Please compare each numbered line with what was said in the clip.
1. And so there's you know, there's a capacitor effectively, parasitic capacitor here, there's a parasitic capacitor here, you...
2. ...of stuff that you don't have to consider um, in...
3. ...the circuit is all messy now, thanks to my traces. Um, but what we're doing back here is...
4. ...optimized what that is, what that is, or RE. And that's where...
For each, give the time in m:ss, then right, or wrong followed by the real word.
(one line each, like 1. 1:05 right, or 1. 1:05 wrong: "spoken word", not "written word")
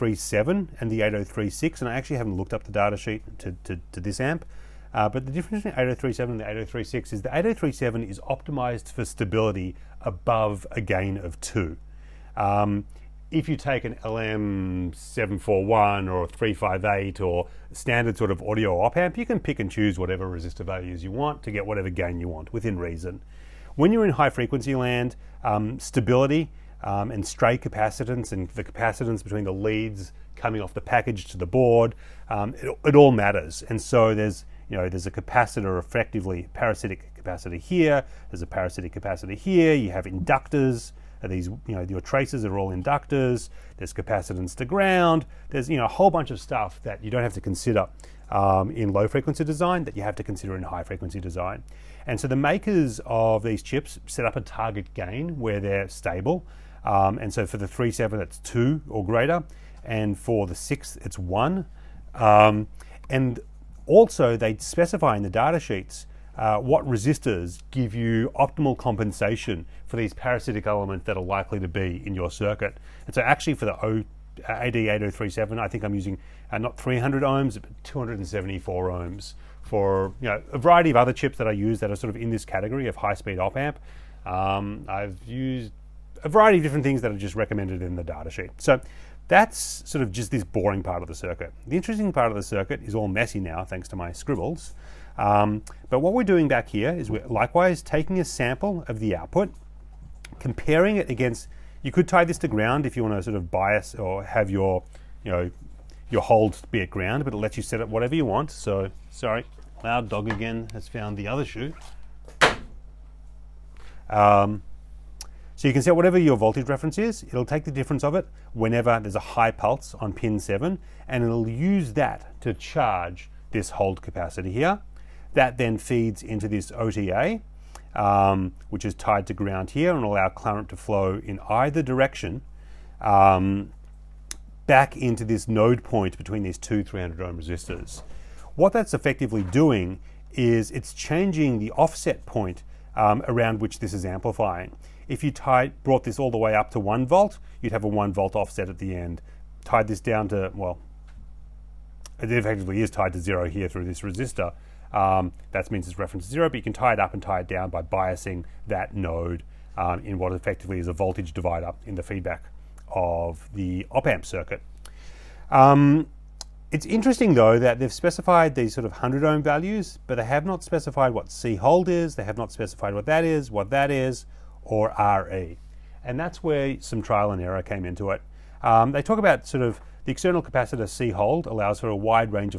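1. 0:33 right
2. 0:46 right
3. 1:32 wrong: "scribbles", not "traces"
4. 2:52 wrong: "specified", not "optimized".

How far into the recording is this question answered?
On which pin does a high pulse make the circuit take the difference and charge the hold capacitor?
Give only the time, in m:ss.
2:00.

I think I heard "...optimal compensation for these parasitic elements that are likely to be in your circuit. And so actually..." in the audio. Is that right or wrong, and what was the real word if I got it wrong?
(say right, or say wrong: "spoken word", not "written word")
right.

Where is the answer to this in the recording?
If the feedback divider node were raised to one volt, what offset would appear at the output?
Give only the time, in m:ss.
2:27.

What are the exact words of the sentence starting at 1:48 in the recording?
So, sorry, loud dog again has found the other shoe.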